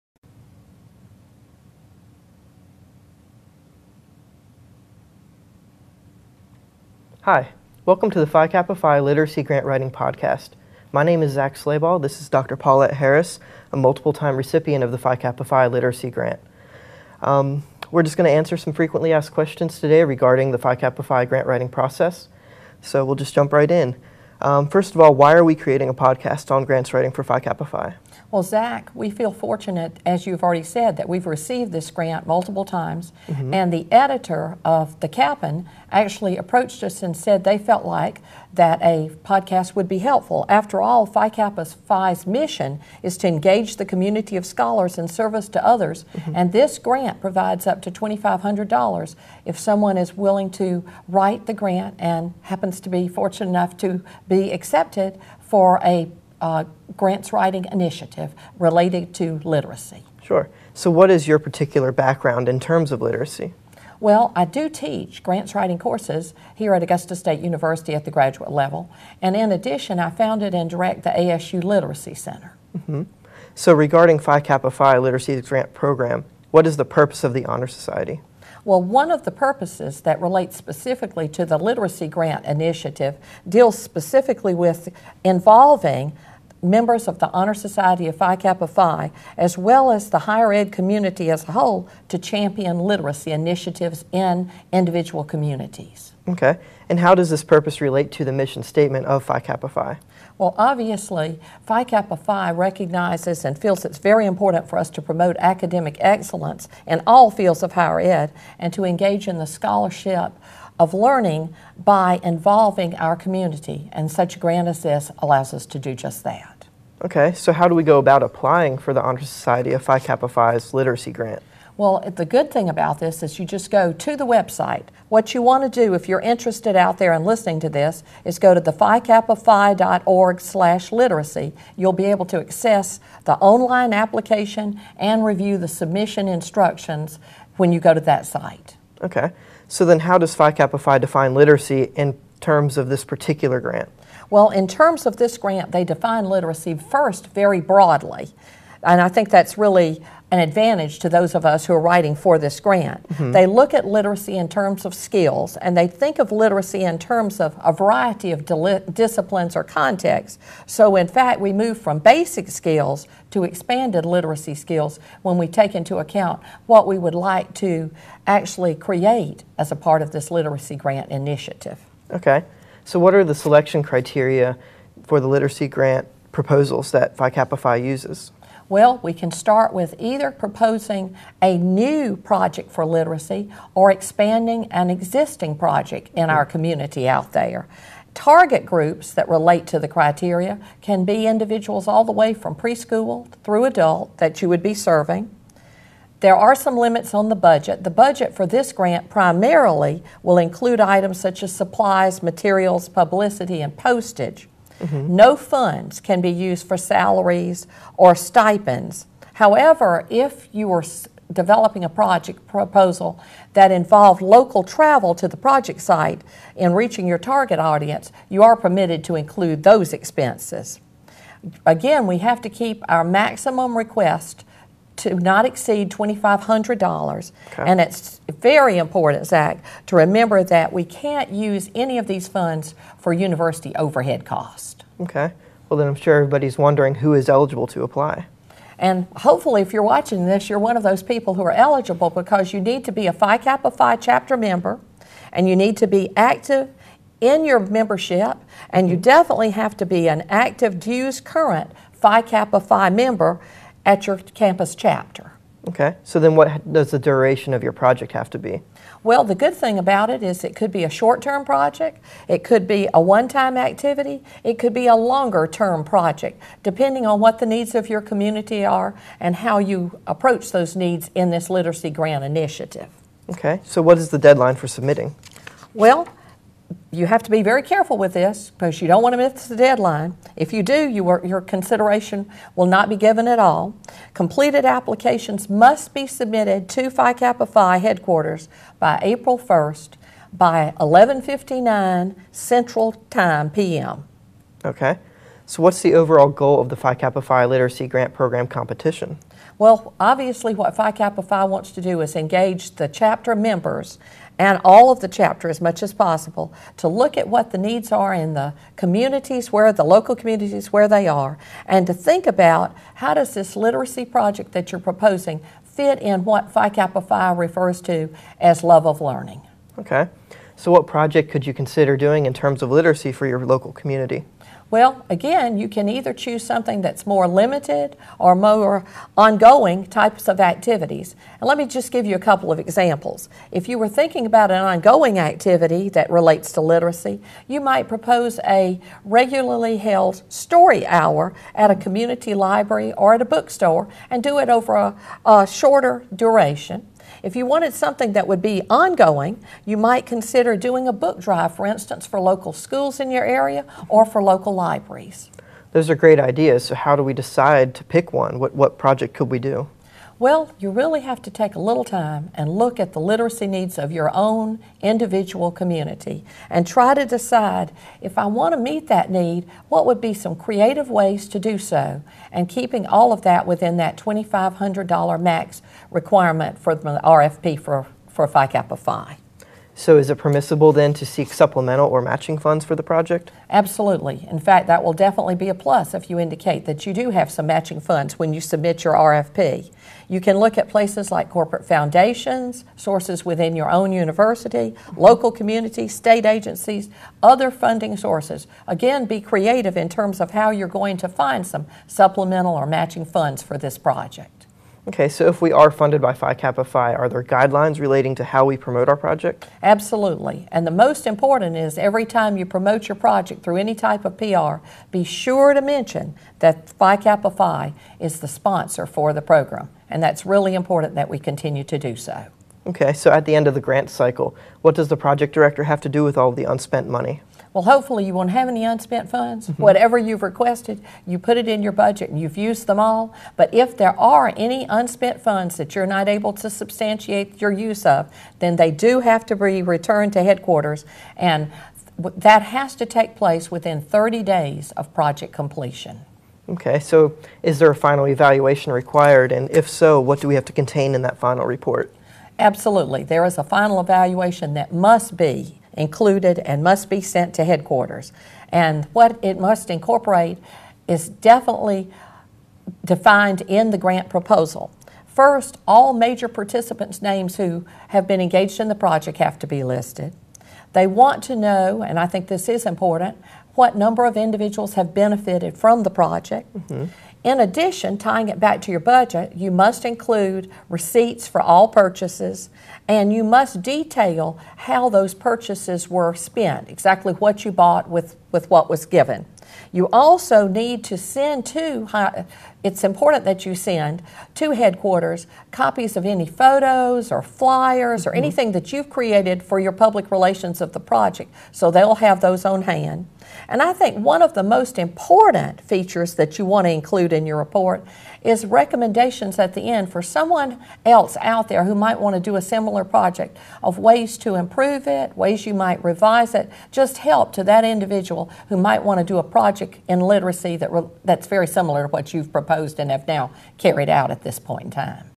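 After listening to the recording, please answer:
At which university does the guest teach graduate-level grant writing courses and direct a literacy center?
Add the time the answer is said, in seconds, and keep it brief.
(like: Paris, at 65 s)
Augusta State University, at 66 s.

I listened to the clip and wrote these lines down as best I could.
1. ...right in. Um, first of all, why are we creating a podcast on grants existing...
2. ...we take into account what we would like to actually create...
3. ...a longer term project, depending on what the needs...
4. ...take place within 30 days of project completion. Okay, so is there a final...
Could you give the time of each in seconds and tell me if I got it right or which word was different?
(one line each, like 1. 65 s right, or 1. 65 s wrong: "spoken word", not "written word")
1. 23 s wrong: "writing", not "existing"
2. 165 s right
3. 264 s right
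4. 442 s right.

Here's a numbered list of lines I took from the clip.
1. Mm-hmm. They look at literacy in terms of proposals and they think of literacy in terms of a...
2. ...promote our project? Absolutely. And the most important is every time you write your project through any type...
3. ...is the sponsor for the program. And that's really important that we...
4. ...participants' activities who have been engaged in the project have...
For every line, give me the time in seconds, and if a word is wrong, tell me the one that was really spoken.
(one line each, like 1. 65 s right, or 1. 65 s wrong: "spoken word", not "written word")
1. 153 s wrong: "skills", not "proposals"
2. 408 s wrong: "promote", not "write"
3. 417 s right
4. 466 s wrong: "names", not "activities".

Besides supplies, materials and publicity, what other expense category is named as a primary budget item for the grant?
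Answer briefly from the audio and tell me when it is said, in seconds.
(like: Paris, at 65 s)
postage, at 203 s.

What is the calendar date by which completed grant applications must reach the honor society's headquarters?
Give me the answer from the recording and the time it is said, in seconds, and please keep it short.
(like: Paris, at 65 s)
April 1st, at 289 s.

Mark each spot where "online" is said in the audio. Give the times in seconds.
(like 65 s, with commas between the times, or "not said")
133 s.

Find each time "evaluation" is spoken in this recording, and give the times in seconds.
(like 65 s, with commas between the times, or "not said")
448 s, 453 s.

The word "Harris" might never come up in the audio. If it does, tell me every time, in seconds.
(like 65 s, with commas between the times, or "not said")
12 s.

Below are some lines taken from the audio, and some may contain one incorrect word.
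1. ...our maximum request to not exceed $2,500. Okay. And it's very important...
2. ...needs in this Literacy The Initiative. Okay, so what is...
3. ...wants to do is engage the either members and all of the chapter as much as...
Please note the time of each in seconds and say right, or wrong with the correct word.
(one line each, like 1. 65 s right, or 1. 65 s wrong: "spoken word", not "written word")
1. 222 s right
2. 270 s wrong: "Grant", not "The"
3. 301 s wrong: "chapter", not "either".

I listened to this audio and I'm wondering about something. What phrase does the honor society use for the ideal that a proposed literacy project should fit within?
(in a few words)
love of learning.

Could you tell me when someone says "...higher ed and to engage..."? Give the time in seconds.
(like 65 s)
107 s.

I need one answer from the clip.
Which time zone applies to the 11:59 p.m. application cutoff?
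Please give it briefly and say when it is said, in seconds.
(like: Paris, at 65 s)
Central Time, at 292 s.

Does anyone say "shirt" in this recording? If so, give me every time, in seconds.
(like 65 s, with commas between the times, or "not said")
not said.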